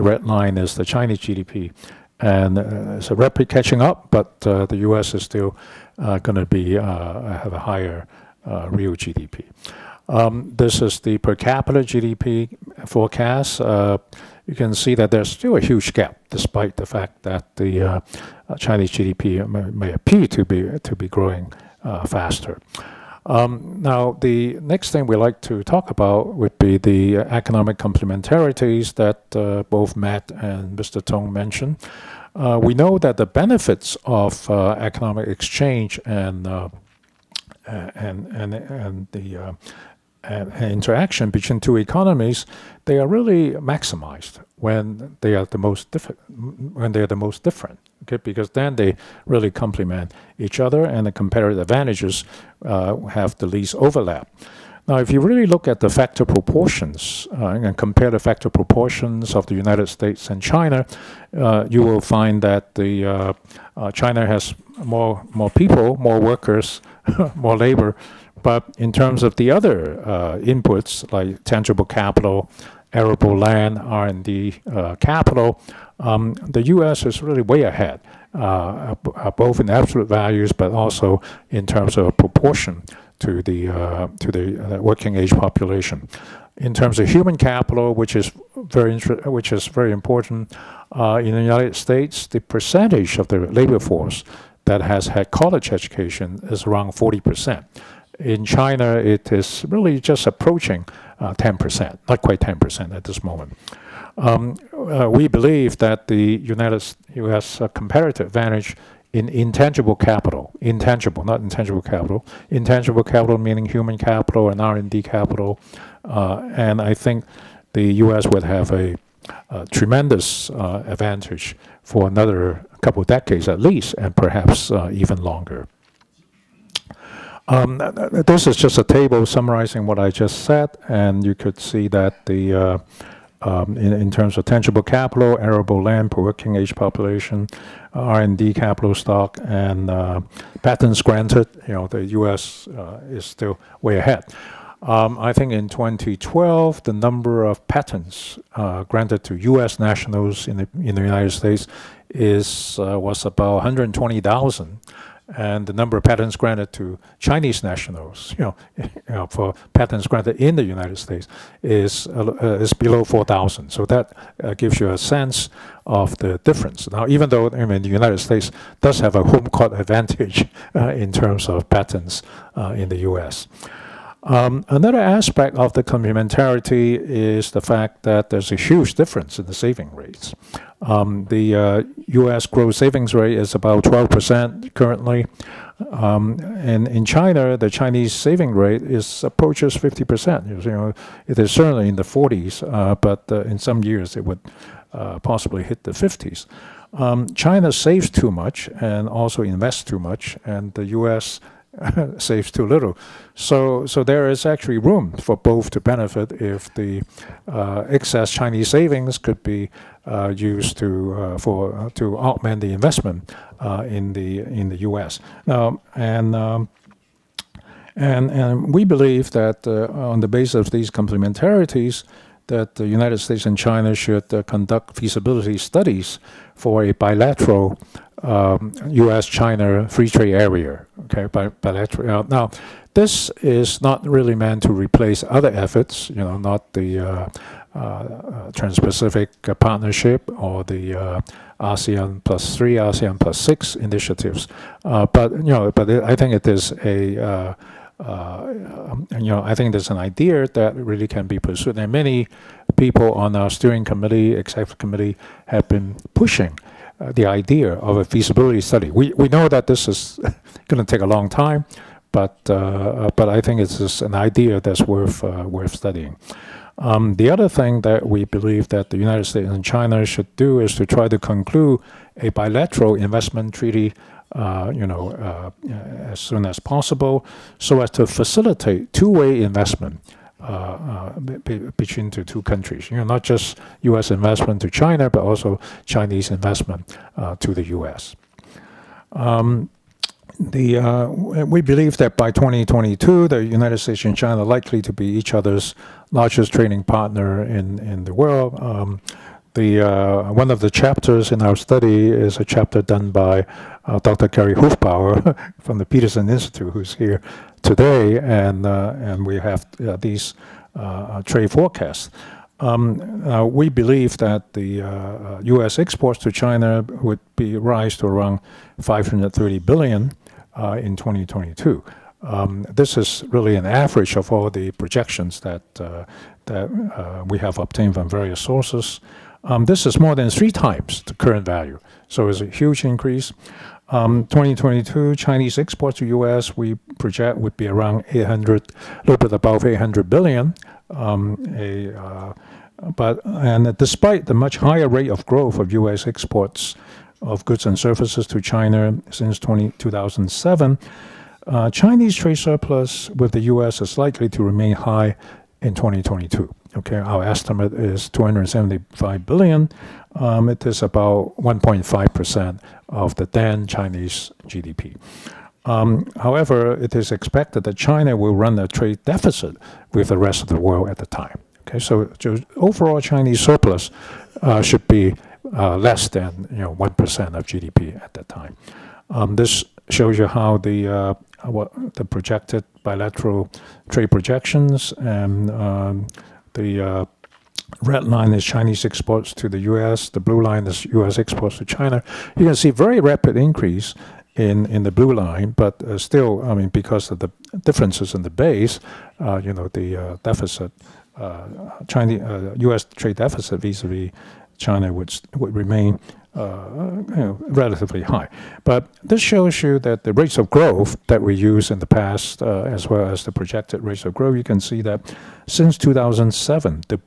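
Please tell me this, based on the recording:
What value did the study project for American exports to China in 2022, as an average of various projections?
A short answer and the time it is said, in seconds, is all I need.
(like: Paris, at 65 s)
530 billion, at 318 s.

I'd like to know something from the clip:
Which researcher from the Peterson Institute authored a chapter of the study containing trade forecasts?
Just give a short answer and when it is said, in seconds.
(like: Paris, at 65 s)
Gary Hufbauer, at 304 s.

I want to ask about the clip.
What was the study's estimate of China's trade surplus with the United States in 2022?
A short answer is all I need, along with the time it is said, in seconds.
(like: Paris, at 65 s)
275 billion, at 358 s.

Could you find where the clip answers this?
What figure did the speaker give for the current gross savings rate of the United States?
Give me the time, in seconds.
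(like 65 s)
183 s.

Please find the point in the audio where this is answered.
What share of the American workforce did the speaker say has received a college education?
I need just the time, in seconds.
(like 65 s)
96 s.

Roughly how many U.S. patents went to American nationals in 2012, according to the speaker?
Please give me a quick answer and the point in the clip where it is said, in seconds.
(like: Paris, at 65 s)
120,000, at 153 s.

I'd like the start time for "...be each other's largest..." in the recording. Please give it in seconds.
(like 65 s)
294 s.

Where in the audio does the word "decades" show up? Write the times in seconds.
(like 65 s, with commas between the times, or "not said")
123 s.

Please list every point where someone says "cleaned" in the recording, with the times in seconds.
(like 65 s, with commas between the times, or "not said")
not said.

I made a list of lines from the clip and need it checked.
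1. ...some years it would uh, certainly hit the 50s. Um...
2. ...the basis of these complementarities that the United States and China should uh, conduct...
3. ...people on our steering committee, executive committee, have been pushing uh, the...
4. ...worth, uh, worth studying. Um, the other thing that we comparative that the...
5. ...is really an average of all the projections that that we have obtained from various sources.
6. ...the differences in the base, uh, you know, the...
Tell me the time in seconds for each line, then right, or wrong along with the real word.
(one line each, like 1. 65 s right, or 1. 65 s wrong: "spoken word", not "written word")
1. 193 s wrong: "possibly", not "certainly"
2. 220 s right
3. 252 s right
4. 264 s wrong: "believe", not "comparative"
5. 322 s right
6. 397 s right.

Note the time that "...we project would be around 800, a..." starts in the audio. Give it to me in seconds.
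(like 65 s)
336 s.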